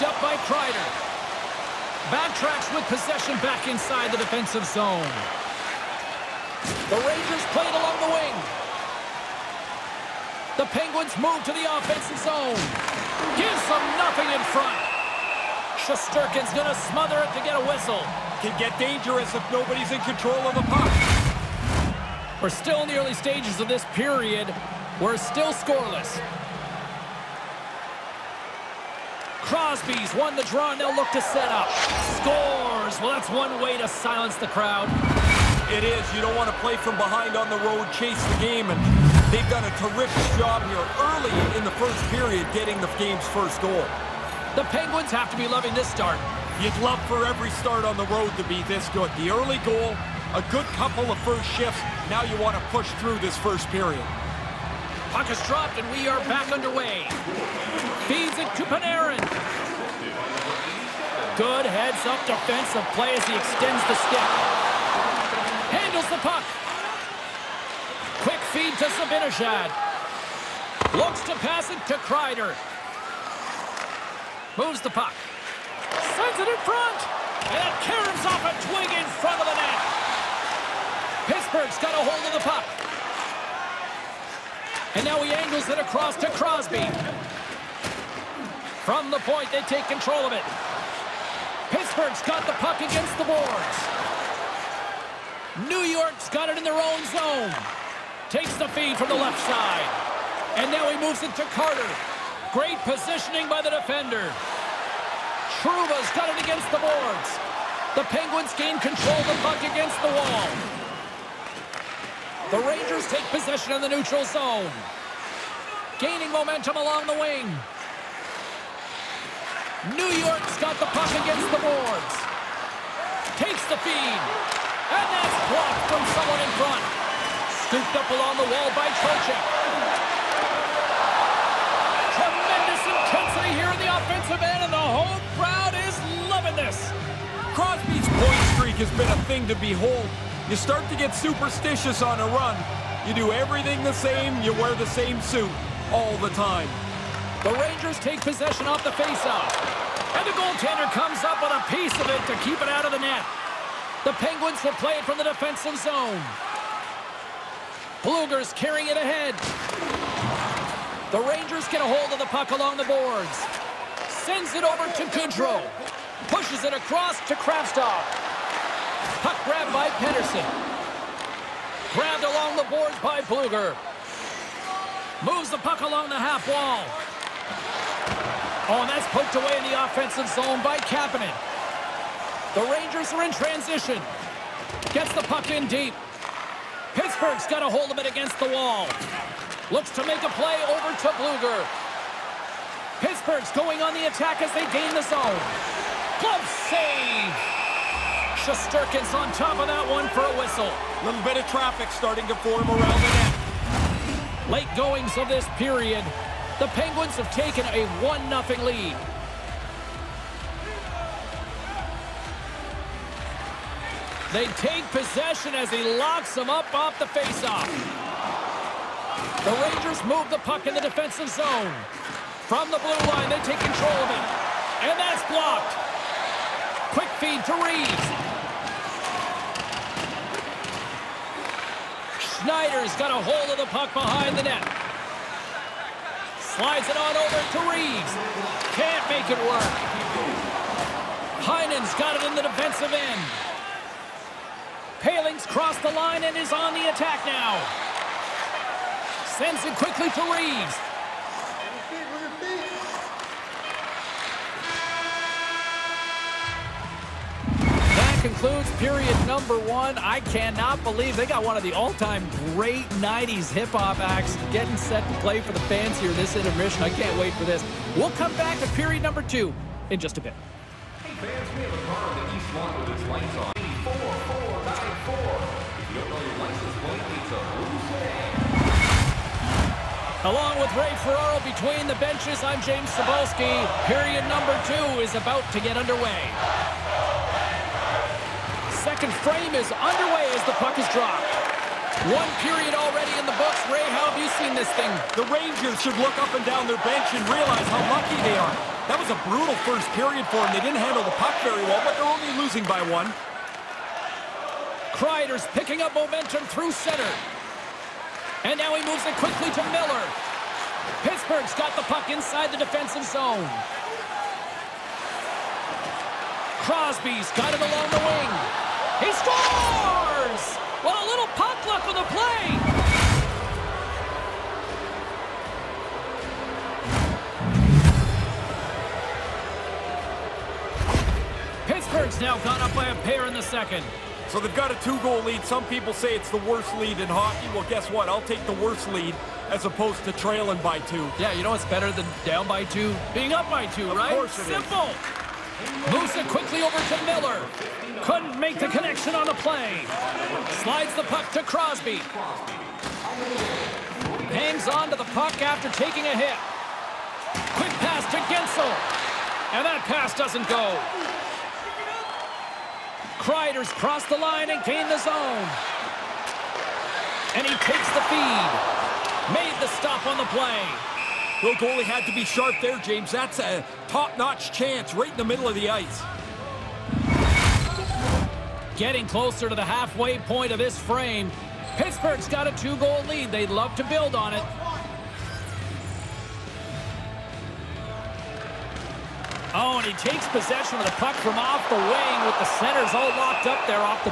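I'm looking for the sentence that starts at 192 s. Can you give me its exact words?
Pittsburgh's going on the attack as they gain the zone.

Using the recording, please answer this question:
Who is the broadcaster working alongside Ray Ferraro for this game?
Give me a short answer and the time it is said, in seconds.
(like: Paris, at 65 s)
James Cybulski, at 282 s.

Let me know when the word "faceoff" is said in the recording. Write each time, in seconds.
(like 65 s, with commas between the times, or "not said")
148 s, 217 s.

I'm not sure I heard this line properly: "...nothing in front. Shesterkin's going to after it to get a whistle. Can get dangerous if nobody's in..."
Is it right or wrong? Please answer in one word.
wrong.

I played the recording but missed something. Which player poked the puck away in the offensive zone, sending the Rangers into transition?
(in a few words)
Kapanen.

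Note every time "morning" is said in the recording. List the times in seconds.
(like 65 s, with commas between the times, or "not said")
not said.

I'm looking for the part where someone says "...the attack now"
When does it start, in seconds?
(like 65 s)
246 s.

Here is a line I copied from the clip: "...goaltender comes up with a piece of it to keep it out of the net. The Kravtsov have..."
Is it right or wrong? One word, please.
wrong.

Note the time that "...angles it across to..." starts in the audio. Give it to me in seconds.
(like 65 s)
85 s.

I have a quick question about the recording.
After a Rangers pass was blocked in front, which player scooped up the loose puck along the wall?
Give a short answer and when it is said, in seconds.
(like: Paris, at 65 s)
Trocheck, at 128 s.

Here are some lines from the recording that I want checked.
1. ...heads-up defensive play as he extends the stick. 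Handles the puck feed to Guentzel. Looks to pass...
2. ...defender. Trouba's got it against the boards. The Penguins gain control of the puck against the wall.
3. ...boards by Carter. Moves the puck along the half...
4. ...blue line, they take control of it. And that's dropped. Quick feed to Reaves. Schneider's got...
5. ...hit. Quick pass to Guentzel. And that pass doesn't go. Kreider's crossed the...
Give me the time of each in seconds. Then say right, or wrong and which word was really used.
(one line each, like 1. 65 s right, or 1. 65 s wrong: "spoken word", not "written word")
1. 61 s wrong: "Zibanejad", not "Guentzel"
2. 103 s right
3. 172 s wrong: "Blueger", not "Carter"
4. 222 s wrong: "blocked", not "dropped"
5. 356 s right.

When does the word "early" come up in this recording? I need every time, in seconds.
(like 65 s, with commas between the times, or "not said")
22 s, 41 s, 49 s.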